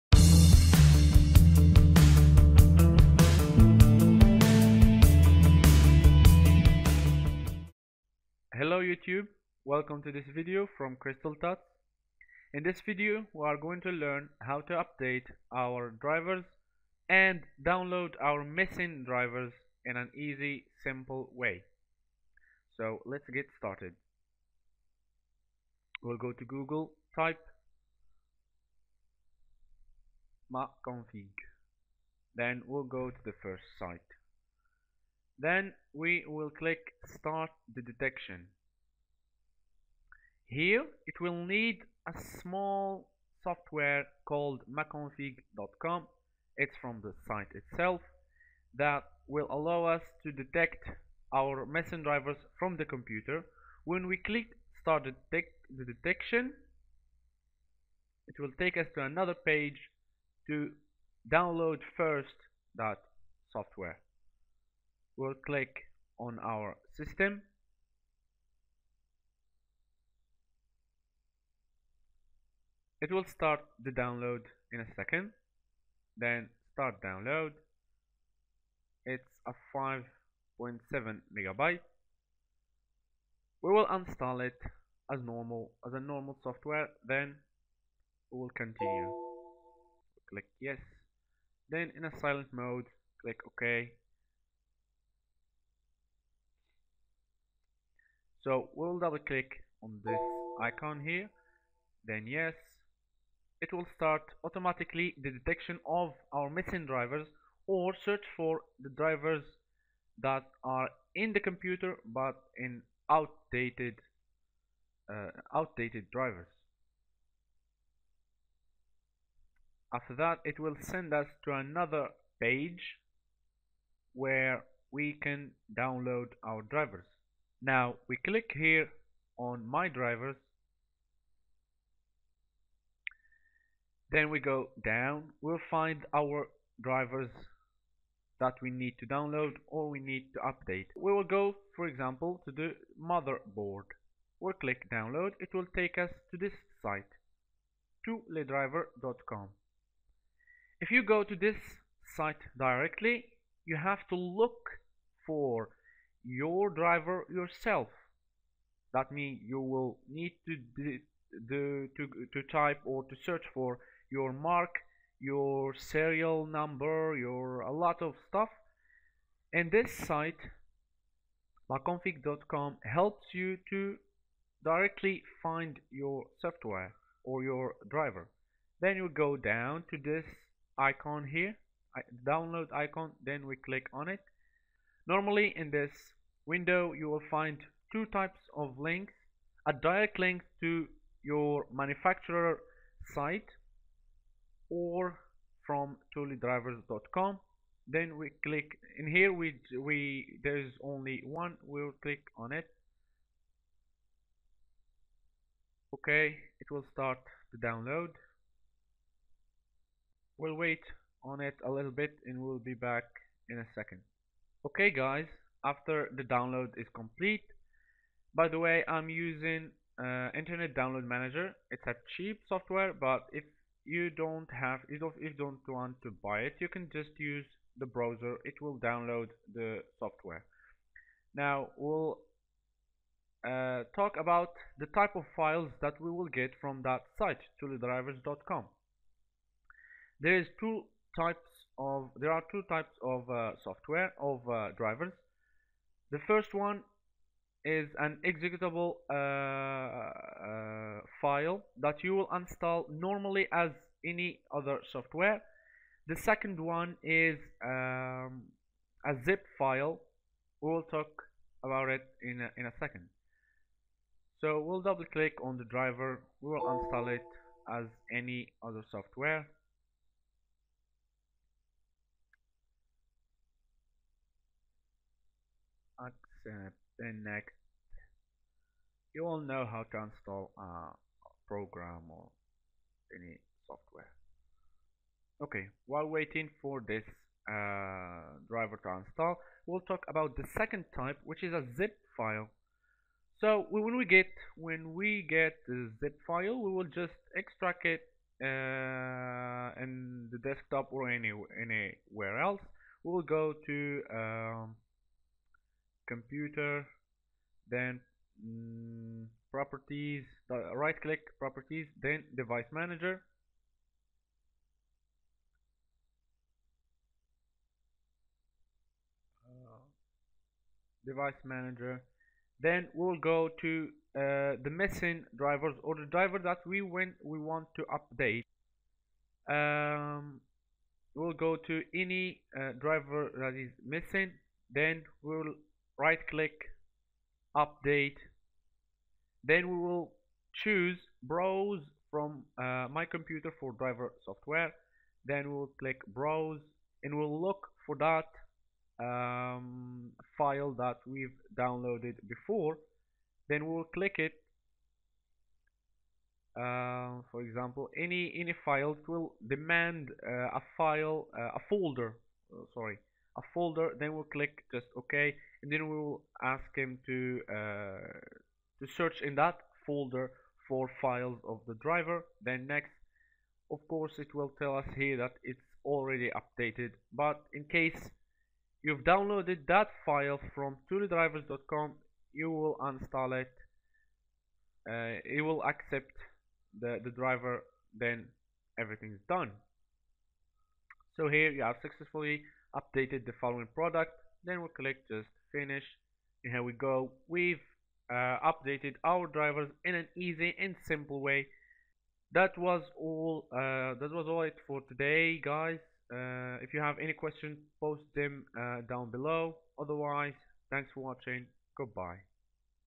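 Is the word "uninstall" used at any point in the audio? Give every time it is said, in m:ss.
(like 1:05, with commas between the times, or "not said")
6:22.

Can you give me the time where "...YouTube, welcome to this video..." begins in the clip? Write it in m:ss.
0:08.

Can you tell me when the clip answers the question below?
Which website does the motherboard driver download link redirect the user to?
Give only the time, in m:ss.
2:28.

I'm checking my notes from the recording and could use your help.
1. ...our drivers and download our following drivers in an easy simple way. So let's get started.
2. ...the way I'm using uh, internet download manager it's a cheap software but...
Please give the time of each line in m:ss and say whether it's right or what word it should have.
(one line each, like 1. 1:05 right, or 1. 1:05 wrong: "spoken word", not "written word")
1. 0:15 wrong: "missing", not "following"
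2. 3:38 right.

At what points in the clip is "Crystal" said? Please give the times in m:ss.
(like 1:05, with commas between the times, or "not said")
0:10.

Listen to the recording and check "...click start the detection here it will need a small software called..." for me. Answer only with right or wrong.
right.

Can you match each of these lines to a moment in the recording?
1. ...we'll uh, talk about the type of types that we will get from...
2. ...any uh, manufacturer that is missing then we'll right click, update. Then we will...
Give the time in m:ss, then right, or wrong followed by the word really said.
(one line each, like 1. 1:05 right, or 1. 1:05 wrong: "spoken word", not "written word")
1. 3:51 wrong: "files", not "types"
2. 5:31 wrong: "driver", not "manufacturer".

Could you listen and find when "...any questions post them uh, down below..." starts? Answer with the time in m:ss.
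6:46.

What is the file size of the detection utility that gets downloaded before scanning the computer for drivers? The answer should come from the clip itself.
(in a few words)
5.7 MB.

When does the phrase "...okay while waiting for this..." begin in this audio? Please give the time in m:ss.
4:45.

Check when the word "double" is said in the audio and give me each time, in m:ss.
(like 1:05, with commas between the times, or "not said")
1:38, 4:24.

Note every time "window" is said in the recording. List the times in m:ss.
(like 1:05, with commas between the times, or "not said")
3:06.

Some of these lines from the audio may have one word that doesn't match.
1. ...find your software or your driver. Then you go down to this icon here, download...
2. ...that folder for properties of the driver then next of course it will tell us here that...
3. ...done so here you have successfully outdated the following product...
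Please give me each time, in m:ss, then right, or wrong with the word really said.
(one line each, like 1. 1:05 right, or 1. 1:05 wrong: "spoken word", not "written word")
1. 2:55 right
2. 6:09 wrong: "files", not "properties"
3. 6:29 wrong: "updated", not "outdated".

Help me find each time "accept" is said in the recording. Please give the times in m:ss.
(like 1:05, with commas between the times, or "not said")
4:35, 6:25.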